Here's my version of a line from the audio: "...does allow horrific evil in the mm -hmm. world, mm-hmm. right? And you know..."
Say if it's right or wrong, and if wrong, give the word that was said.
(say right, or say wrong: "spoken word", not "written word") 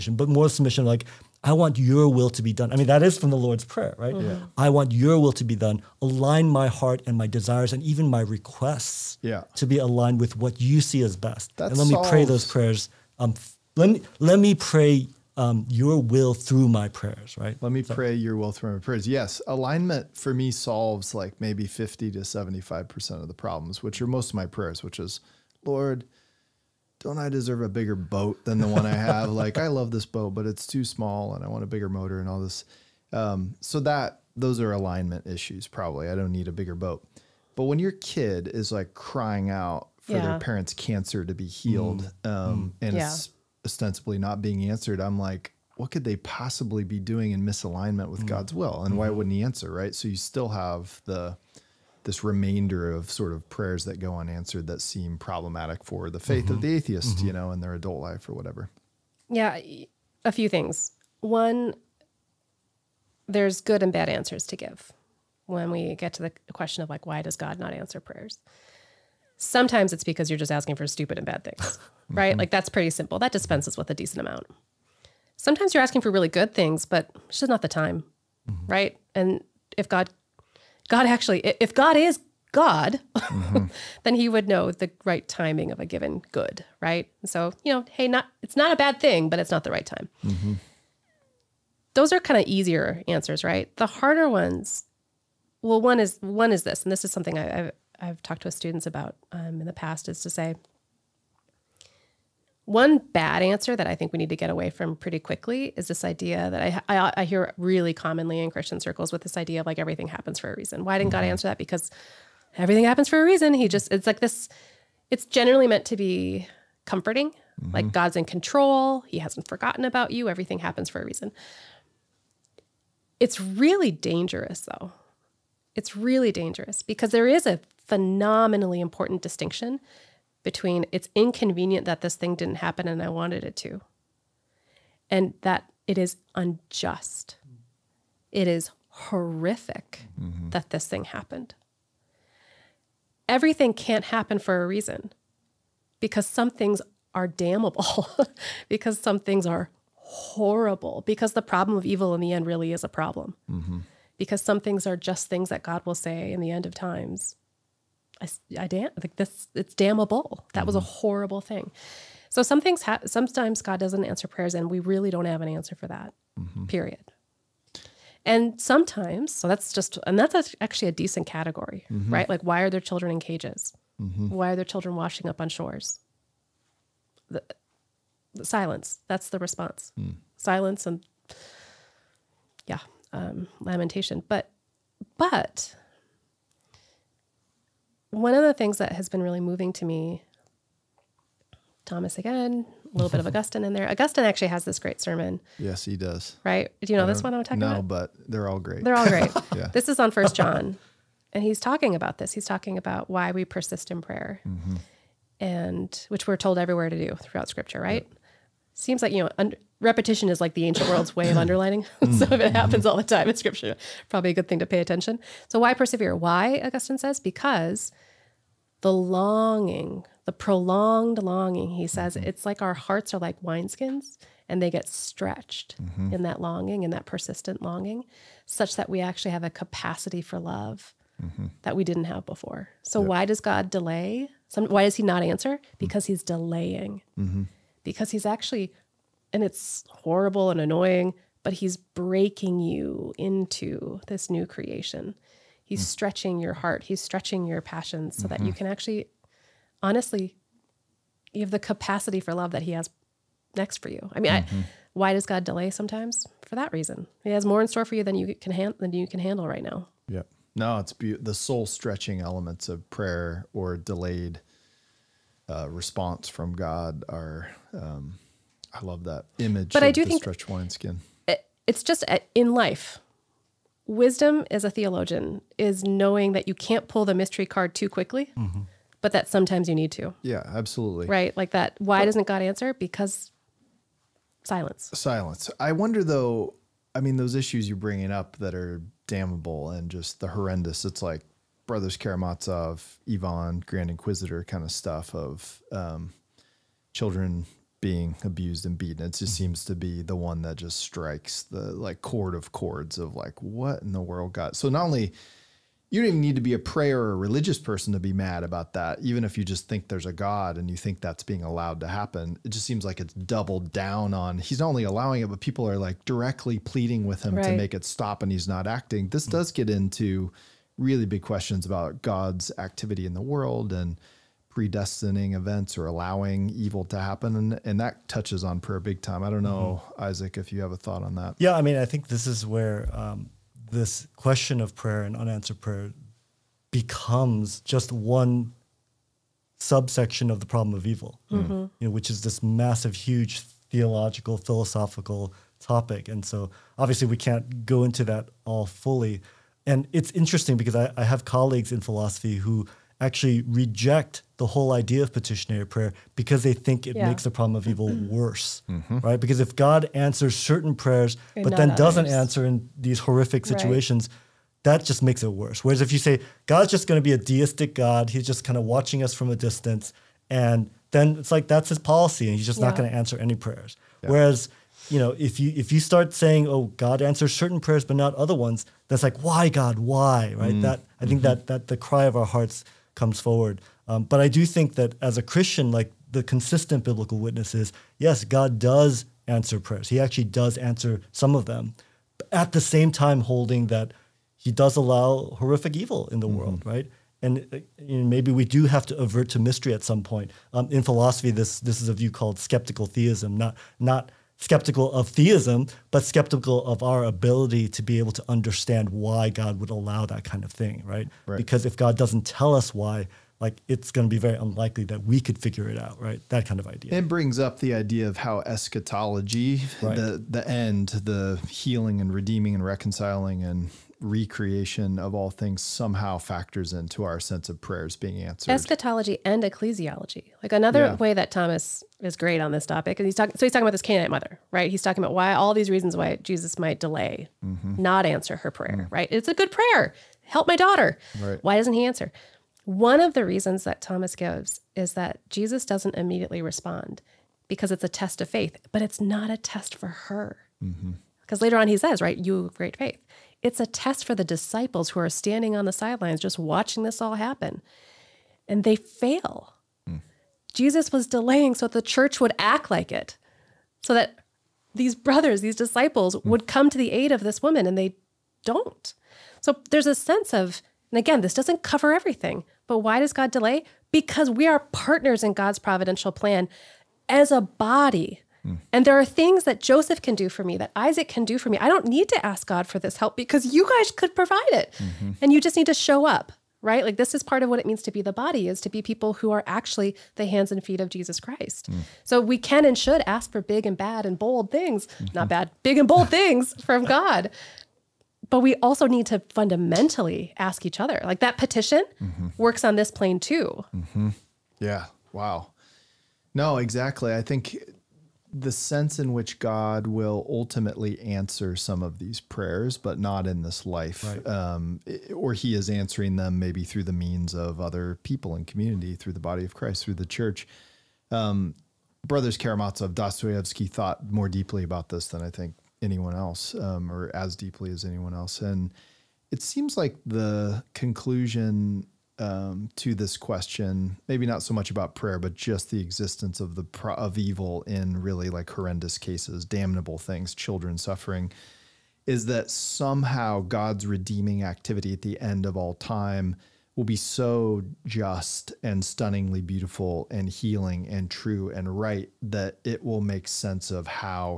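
right.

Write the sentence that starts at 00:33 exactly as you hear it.
Um, so that those are alignment issues, probably.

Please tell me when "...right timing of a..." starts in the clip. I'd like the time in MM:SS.
01:25.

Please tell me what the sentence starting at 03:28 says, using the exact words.
Yep seems like you know un- repetition is like the ancient world's way of mm.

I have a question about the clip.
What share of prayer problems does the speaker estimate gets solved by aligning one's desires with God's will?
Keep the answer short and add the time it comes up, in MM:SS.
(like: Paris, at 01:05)
50 to 75%, at 00:21.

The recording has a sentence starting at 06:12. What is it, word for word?
not going to answer any prayers.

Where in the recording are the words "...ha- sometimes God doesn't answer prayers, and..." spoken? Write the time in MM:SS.
02:42.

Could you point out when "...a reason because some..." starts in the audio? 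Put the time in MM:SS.
02:24.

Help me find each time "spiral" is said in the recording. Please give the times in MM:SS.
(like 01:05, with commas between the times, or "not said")
not said.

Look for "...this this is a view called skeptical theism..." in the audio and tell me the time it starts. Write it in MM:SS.
06:41.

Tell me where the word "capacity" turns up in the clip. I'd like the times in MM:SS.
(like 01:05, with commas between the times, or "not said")
03:49, 04:11.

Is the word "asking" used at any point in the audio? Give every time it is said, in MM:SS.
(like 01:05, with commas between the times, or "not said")
01:10, 01:15.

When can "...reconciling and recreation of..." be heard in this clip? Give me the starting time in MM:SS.
07:02.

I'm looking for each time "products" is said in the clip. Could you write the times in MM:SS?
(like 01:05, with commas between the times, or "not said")
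not said.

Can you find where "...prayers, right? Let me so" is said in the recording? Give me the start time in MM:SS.
00:16.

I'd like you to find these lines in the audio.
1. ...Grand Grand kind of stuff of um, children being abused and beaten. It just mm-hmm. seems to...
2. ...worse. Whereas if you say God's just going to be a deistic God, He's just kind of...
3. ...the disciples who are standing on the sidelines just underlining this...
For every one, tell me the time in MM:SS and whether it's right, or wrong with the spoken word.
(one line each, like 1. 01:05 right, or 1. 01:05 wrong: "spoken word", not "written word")
1. 04:53 wrong: "Inquisitor", not "Grand"
2. 06:05 right
3. 07:34 wrong: "watching", not "underlining".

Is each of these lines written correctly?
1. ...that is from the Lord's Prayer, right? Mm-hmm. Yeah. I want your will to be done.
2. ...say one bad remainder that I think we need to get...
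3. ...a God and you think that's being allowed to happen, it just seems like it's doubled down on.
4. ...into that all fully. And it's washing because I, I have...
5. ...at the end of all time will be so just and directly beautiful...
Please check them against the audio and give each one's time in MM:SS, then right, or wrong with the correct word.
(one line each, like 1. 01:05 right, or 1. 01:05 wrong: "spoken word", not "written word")
1. 00:02 right
2. 01:40 wrong: "answer", not "remainder"
3. 05:10 right
4. 05:47 wrong: "interesting", not "washing"
5. 09:04 wrong: "stunningly", not "directly".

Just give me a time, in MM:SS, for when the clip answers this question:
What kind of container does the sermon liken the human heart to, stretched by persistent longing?
03:43.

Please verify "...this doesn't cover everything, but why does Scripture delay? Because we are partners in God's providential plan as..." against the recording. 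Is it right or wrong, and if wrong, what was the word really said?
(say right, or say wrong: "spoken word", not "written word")
wrong: "God", not "Scripture".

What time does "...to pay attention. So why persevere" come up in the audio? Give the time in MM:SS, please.
03:34.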